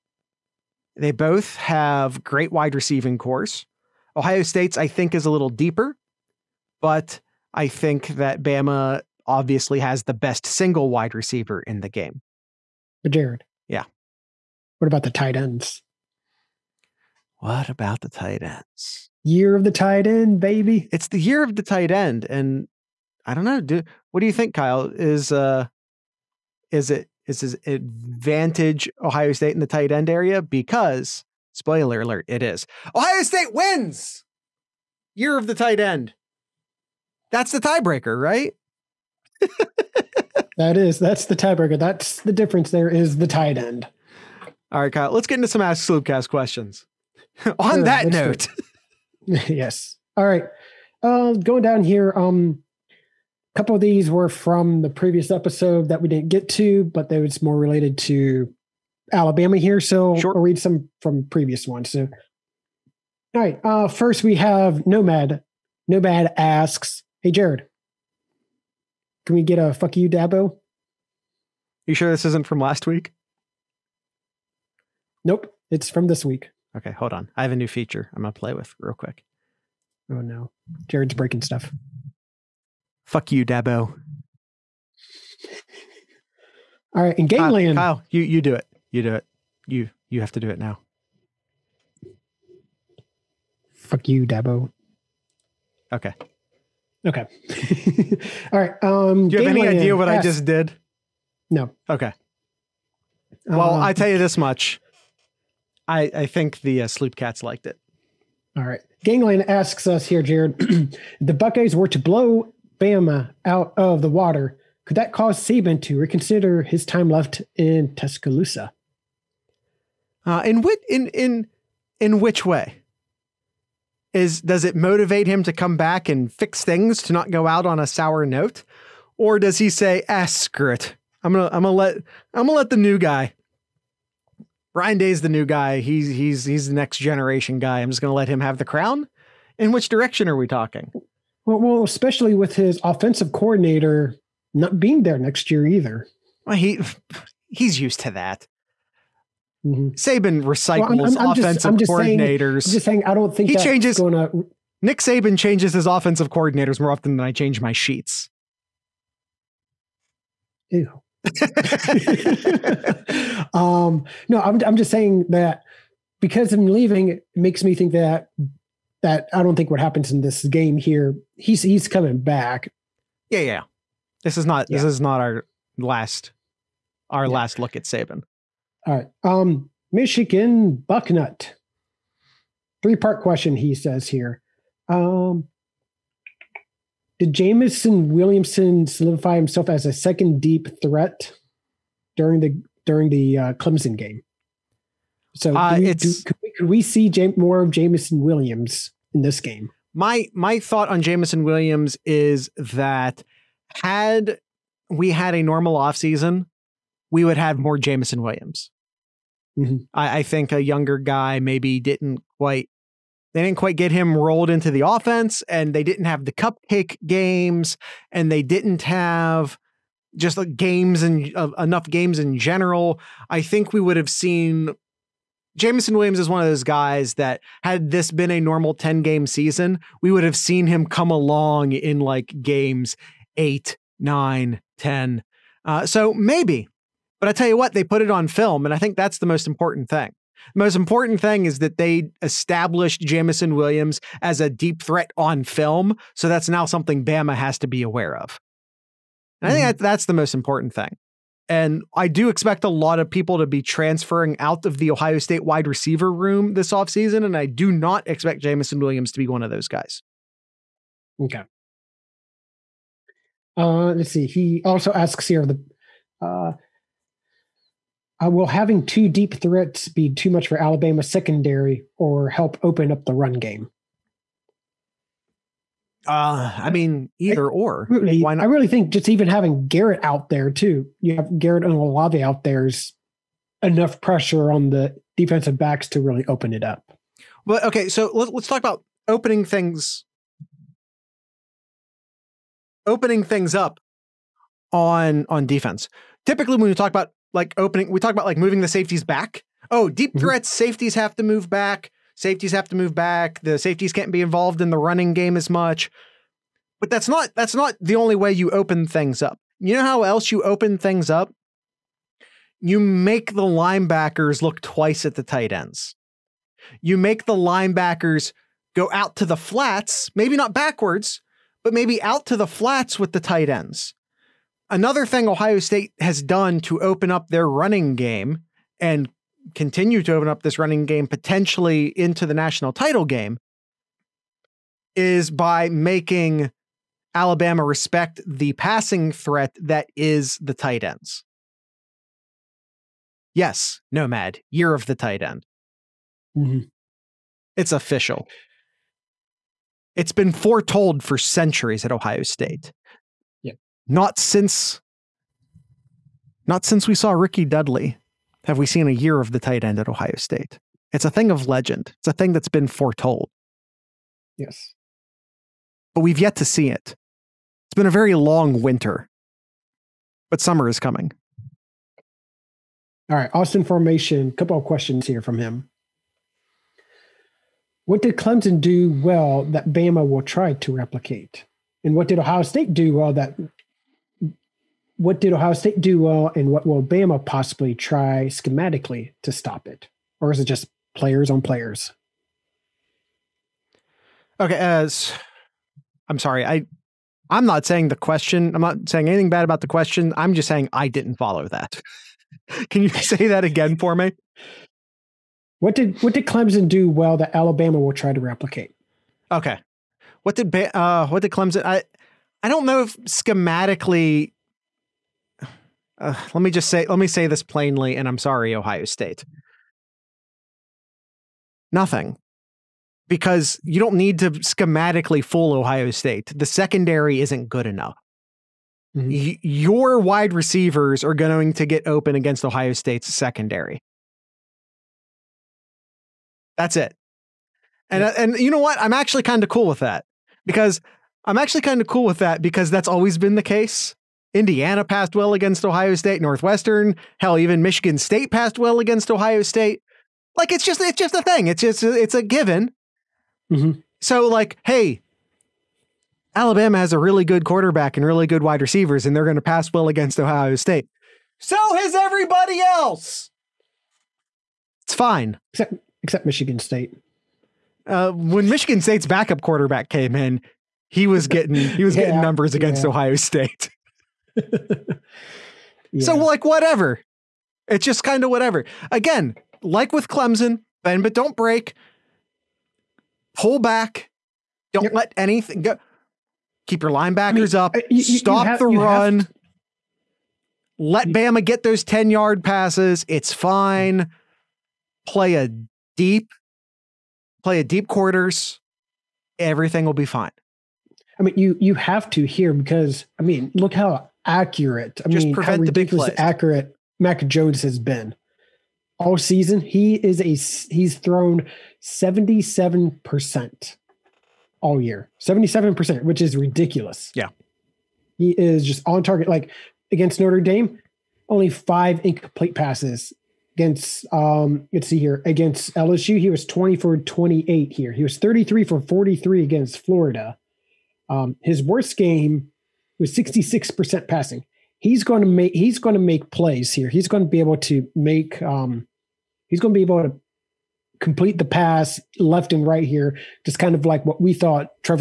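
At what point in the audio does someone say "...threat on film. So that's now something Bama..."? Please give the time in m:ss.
4:04.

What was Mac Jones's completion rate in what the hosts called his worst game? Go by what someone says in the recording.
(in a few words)
66%.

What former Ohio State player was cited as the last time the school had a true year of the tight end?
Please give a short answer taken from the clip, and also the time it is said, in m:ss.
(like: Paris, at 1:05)
Ricky Dudley, at 5:57.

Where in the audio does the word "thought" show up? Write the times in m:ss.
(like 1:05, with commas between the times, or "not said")
3:20, 9:04.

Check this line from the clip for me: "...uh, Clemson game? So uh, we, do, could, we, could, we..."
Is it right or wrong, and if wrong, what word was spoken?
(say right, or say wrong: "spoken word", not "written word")
right.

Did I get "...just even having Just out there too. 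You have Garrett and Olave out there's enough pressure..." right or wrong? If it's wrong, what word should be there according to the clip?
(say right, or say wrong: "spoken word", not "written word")
wrong: "Garrett", not "Just".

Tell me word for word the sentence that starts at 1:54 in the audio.
Could that cause Saban to reconsider his time left in Tuscaloosa?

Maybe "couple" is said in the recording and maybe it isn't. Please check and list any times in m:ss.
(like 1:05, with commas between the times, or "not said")
0:53, 6:14.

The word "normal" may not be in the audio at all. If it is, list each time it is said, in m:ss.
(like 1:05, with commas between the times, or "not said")
3:25, 3:48.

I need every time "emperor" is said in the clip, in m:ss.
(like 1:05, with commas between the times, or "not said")
not said.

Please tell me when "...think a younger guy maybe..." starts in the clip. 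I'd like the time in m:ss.
3:30.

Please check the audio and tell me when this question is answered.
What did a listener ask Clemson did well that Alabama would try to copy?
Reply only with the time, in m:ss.
6:13.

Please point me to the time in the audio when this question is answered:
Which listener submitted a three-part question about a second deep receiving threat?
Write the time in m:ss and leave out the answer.
2:59.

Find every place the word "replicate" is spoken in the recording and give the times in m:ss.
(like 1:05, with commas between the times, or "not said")
6:20, 6:48.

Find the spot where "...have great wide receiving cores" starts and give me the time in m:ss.
0:01.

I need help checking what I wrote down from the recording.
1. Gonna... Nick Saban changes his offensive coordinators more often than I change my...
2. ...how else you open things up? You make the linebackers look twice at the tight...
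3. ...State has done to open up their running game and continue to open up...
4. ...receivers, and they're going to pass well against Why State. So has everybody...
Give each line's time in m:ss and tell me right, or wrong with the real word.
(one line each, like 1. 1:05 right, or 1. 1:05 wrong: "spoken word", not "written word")
1. 2:33 right
2. 5:09 right
3. 5:25 right
4. 7:38 wrong: "Ohio", not "Why".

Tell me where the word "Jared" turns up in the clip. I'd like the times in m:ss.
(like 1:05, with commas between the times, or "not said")
0:13, 1:07, 1:20, 1:50.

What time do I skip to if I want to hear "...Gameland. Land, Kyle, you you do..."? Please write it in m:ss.
1:27.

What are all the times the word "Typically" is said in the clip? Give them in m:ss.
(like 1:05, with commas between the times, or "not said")
4:56.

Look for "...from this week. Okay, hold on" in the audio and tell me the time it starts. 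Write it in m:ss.
1:15.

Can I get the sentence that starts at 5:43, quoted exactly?
Yes, Nomad, year of the tight end.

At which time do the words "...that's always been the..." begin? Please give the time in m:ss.
7:22.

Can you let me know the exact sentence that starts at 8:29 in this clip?
He is a he's thrown seventy seven percent all year, seventy seven percent, which is ridiculous.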